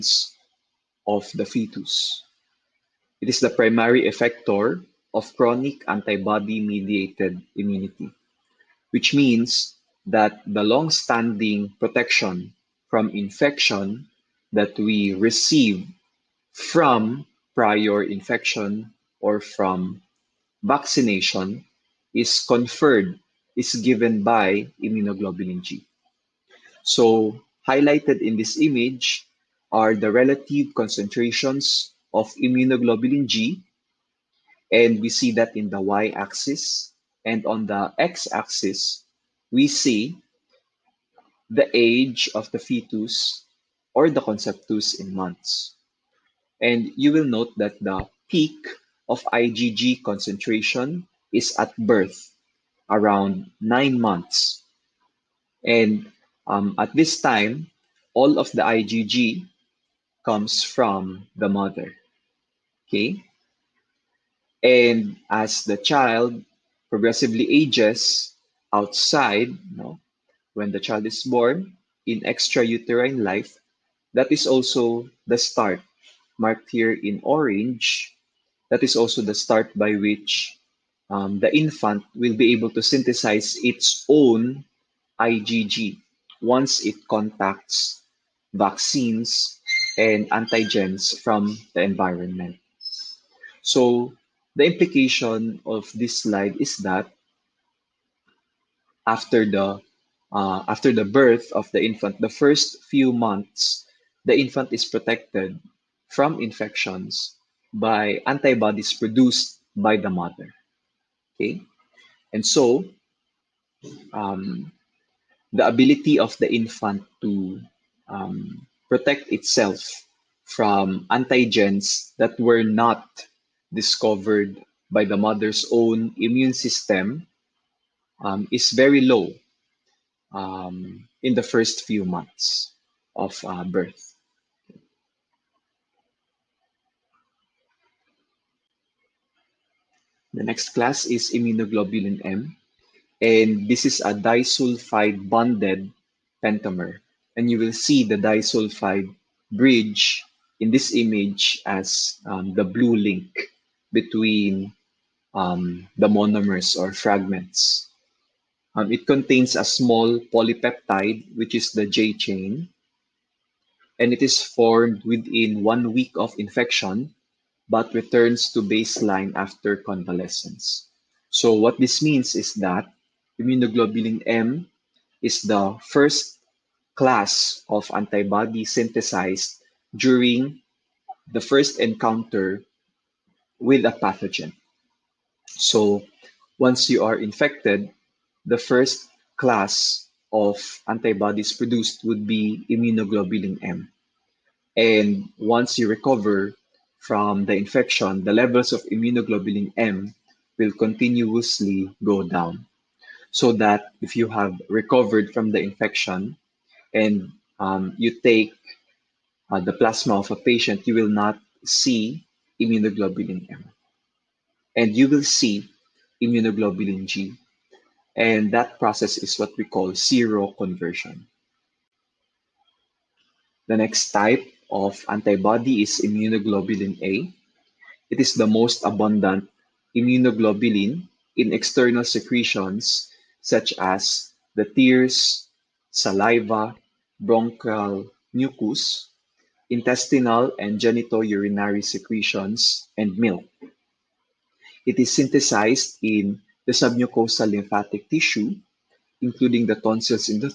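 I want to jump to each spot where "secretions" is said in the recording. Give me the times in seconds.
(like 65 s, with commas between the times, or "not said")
232 s, 241 s.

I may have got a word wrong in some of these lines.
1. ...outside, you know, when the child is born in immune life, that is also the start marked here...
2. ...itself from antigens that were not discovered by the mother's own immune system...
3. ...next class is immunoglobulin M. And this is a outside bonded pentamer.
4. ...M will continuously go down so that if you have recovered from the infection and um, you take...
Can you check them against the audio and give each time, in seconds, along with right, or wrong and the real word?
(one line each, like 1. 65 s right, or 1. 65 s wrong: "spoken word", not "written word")
1. 68 s wrong: "extrauterine", not "immune"
2. 119 s right
3. 140 s wrong: "disulfide", not "outside"
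4. 199 s right.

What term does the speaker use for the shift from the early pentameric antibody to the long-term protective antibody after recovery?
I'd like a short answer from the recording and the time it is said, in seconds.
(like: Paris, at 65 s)
Seroconversion, at 219 s.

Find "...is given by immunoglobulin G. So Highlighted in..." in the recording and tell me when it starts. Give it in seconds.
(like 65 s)
23 s.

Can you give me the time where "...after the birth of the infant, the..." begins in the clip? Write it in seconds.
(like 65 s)
100 s.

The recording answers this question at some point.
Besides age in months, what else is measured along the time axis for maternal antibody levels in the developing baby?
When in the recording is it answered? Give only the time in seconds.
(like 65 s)
41 s.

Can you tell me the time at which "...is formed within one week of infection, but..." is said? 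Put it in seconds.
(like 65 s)
164 s.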